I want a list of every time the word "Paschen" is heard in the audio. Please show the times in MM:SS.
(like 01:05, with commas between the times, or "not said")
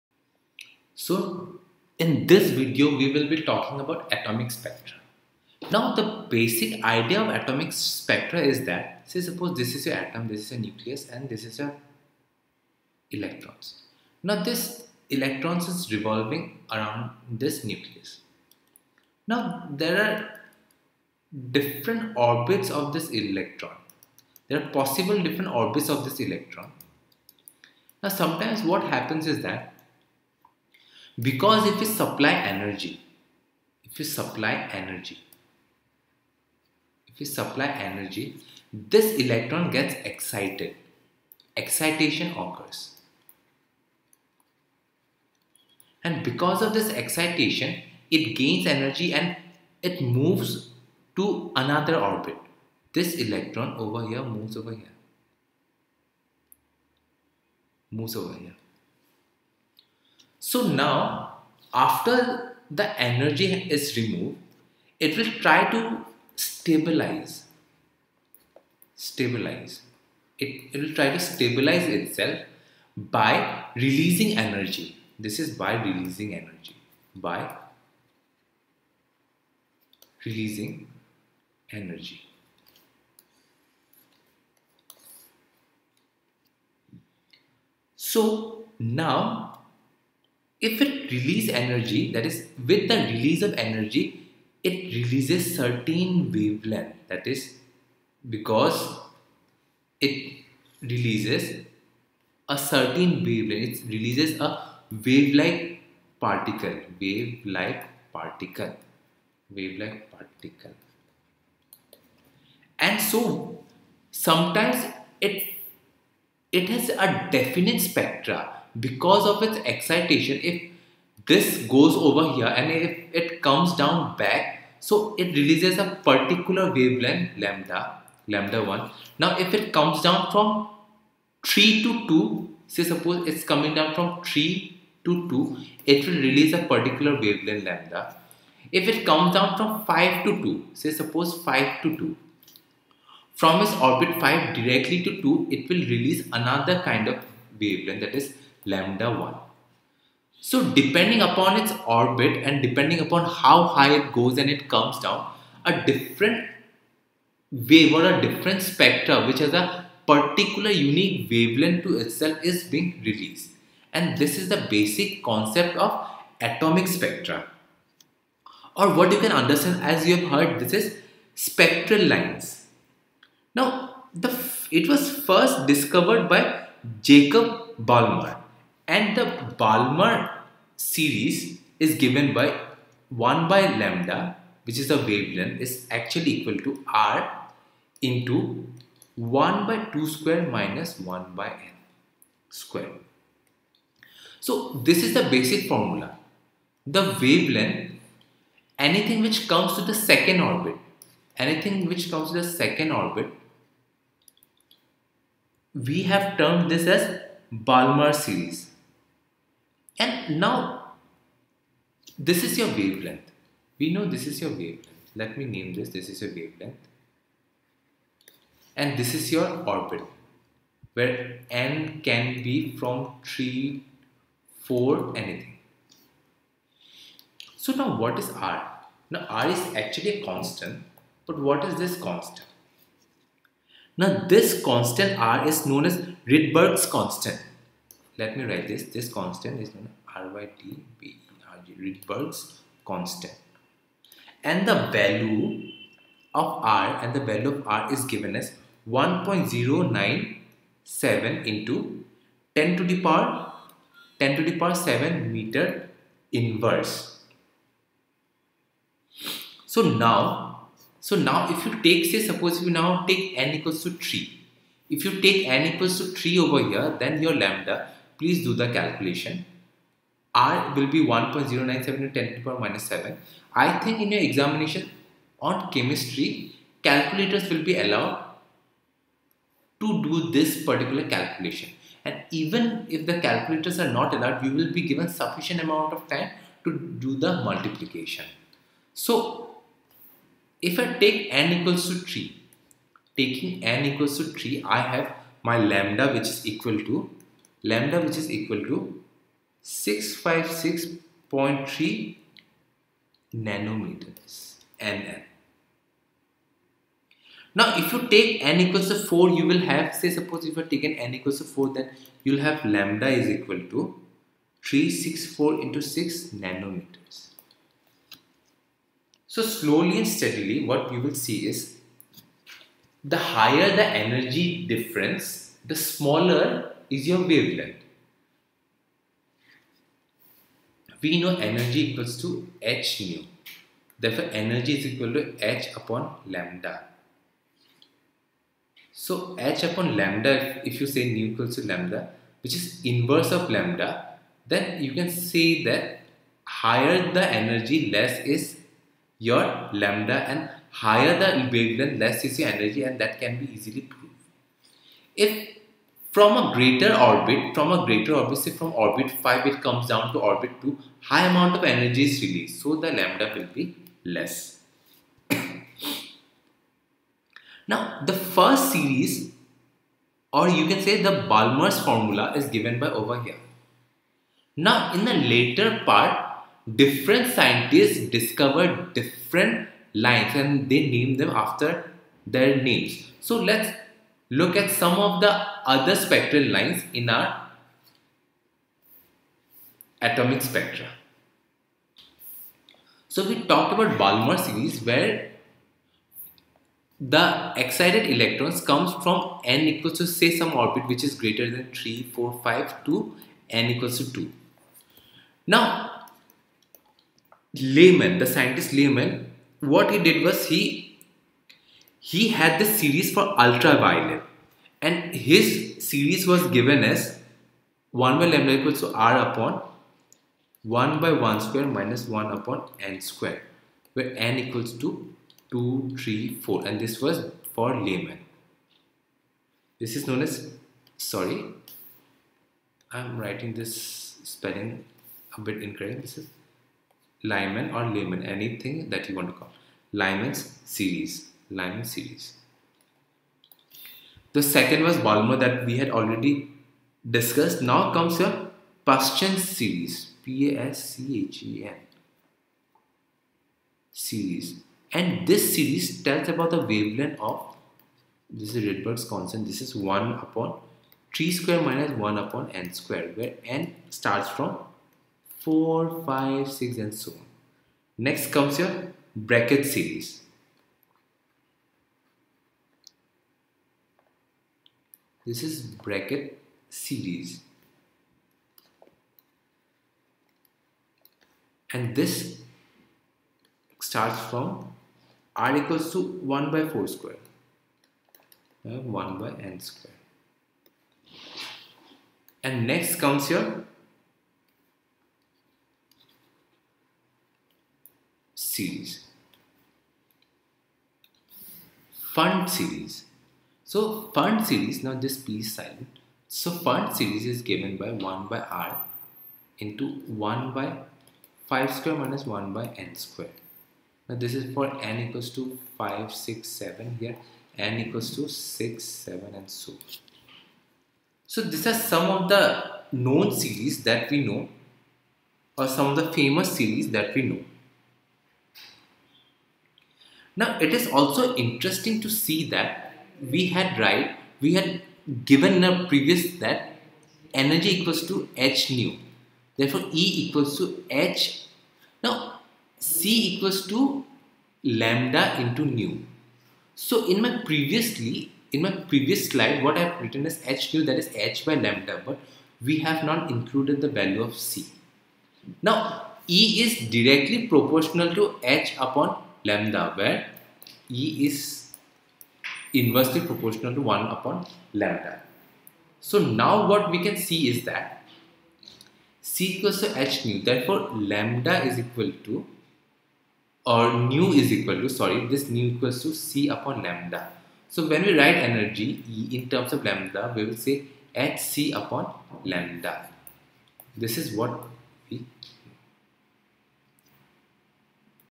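07:28.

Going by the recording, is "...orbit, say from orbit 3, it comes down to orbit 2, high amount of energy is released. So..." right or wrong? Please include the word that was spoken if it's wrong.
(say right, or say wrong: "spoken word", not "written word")
wrong: "5", not "3".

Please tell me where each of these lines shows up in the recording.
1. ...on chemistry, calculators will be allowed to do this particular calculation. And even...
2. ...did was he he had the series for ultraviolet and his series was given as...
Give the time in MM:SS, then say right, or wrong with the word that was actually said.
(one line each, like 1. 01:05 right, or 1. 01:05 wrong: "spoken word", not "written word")
1. 04:35 right
2. 06:49 right.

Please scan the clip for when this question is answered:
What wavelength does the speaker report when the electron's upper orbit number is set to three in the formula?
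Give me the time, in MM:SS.
04:59.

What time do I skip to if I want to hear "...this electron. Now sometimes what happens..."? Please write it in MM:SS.
00:26.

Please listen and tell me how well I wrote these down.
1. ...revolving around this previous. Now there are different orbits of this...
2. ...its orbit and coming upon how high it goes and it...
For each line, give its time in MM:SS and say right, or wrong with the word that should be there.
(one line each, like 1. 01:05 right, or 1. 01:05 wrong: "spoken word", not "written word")
1. 00:15 wrong: "nucleus", not "previous"
2. 02:31 wrong: "depending", not "coming".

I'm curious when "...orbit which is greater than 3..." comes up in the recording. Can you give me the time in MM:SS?
06:40.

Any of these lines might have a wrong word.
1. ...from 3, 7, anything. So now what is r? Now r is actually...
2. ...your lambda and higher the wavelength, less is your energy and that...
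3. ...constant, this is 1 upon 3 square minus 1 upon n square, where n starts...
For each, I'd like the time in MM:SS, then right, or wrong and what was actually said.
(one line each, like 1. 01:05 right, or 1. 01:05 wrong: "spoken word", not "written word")
1. 03:42 wrong: "4", not "7"
2. 05:49 right
3. 07:39 right.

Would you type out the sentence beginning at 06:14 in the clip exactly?
Now, in the later part, different scientists discovered different lines and they name them after their names.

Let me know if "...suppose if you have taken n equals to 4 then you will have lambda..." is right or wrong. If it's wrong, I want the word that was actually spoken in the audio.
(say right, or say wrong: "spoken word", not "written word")
right.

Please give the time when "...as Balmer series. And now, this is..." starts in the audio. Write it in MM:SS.
03:26.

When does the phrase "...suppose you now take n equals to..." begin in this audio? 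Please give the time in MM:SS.
04:22.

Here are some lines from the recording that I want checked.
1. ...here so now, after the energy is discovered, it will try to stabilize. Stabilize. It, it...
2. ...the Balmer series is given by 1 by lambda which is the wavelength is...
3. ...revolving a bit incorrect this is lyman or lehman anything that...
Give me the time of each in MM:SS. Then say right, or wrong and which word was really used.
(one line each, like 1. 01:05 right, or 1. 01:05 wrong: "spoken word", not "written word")
1. 00:58 wrong: "removed", not "discovered"
2. 02:59 right
3. 07:14 wrong: "spelling", not "revolving".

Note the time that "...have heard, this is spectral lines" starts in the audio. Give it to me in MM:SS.
02:50.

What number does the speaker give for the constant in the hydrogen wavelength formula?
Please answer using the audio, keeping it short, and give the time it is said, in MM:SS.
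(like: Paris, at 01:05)
1.097 x 10^7, at 04:08.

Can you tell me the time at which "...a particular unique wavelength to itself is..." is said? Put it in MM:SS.
02:39.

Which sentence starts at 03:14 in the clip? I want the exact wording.
So this is the basic formula.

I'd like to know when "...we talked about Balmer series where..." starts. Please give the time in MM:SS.
06:33.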